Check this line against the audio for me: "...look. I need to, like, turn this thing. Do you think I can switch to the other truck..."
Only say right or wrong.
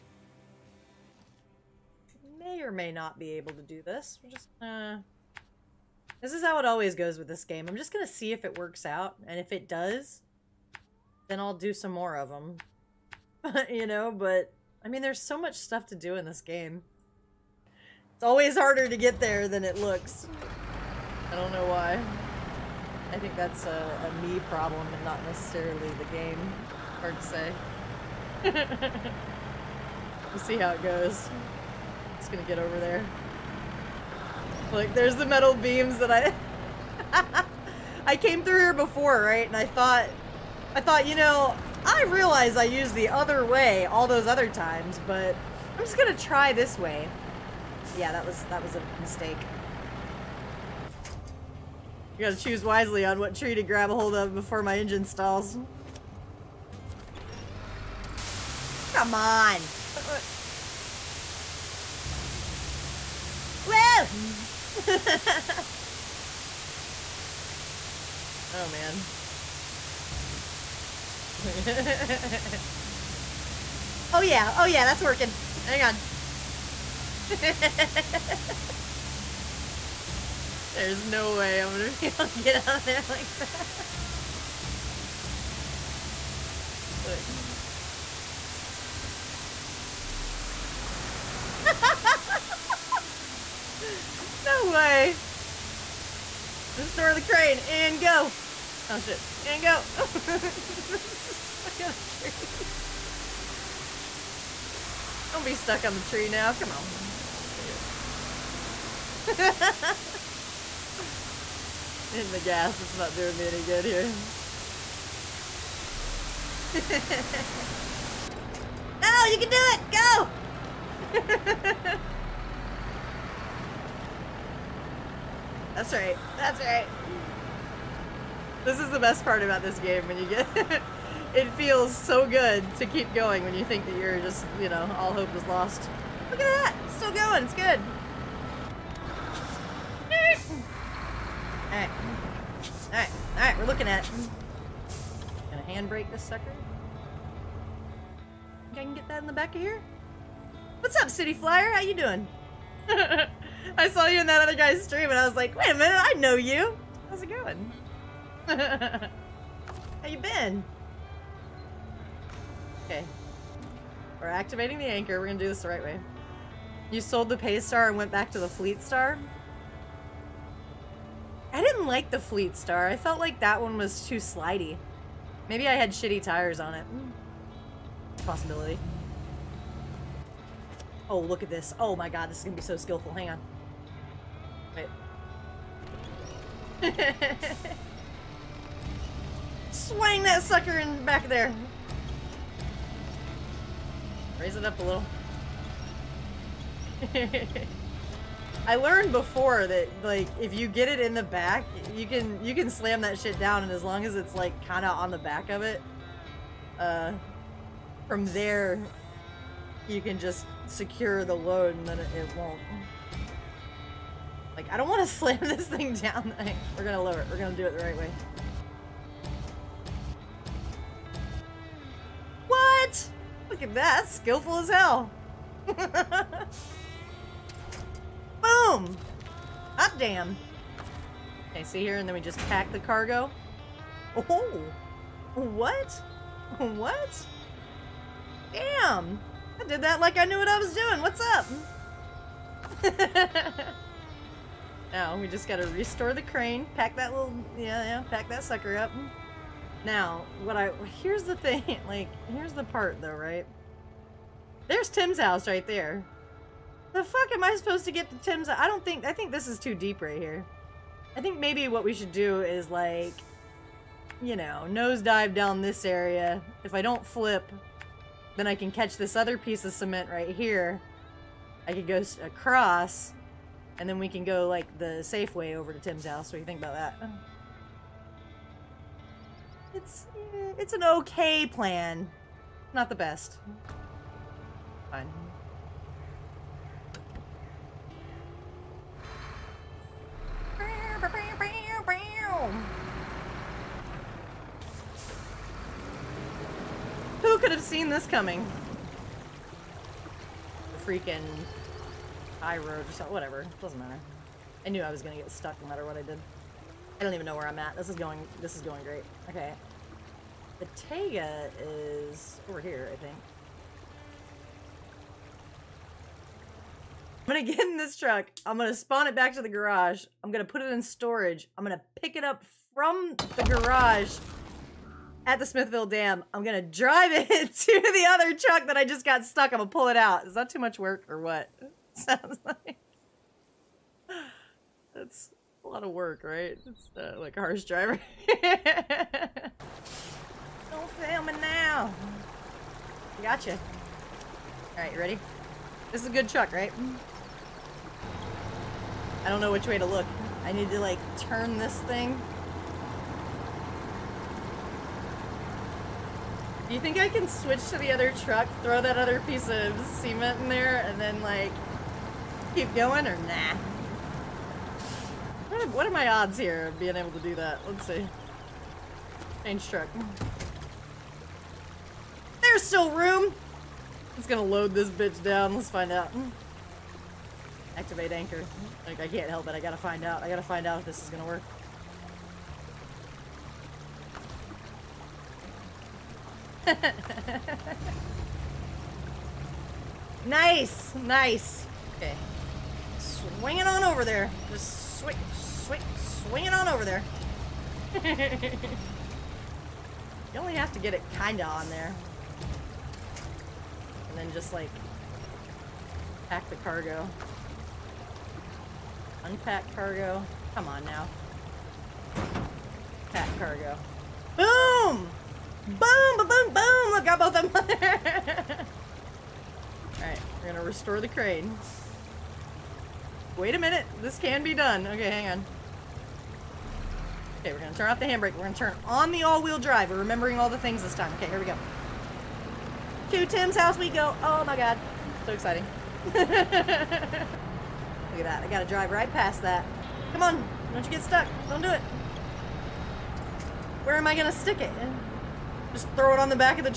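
right.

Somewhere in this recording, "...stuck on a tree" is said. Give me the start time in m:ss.
1:41.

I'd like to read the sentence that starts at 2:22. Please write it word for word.
Alright, alright, we're looking at it.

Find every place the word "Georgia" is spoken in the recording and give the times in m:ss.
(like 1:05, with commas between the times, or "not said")
not said.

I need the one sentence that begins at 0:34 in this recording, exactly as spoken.
Like, there's the metal beams that I...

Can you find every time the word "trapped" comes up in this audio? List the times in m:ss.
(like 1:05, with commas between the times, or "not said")
not said.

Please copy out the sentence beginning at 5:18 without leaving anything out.
I'm gonna spawn it back to the garage.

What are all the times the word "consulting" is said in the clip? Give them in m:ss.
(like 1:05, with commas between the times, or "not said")
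not said.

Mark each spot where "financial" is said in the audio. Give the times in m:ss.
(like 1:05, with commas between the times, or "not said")
not said.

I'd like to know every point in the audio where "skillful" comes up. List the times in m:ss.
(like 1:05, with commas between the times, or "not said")
3:02, 3:44.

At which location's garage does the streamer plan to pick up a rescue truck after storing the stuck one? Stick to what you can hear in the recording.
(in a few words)
Smithville Dam.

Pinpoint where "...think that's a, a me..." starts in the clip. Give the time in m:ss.
0:23.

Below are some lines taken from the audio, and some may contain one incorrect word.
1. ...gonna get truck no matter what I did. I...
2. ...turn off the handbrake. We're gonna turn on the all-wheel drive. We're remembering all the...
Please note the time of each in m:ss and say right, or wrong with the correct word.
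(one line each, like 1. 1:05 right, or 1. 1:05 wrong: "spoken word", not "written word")
1. 5:05 wrong: "stuck", not "truck"
2. 7:07 right.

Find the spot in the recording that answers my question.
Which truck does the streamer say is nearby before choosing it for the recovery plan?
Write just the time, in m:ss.
5:10.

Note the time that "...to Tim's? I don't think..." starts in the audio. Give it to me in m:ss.
4:18.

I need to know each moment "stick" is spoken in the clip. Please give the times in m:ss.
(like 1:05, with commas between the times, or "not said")
7:24.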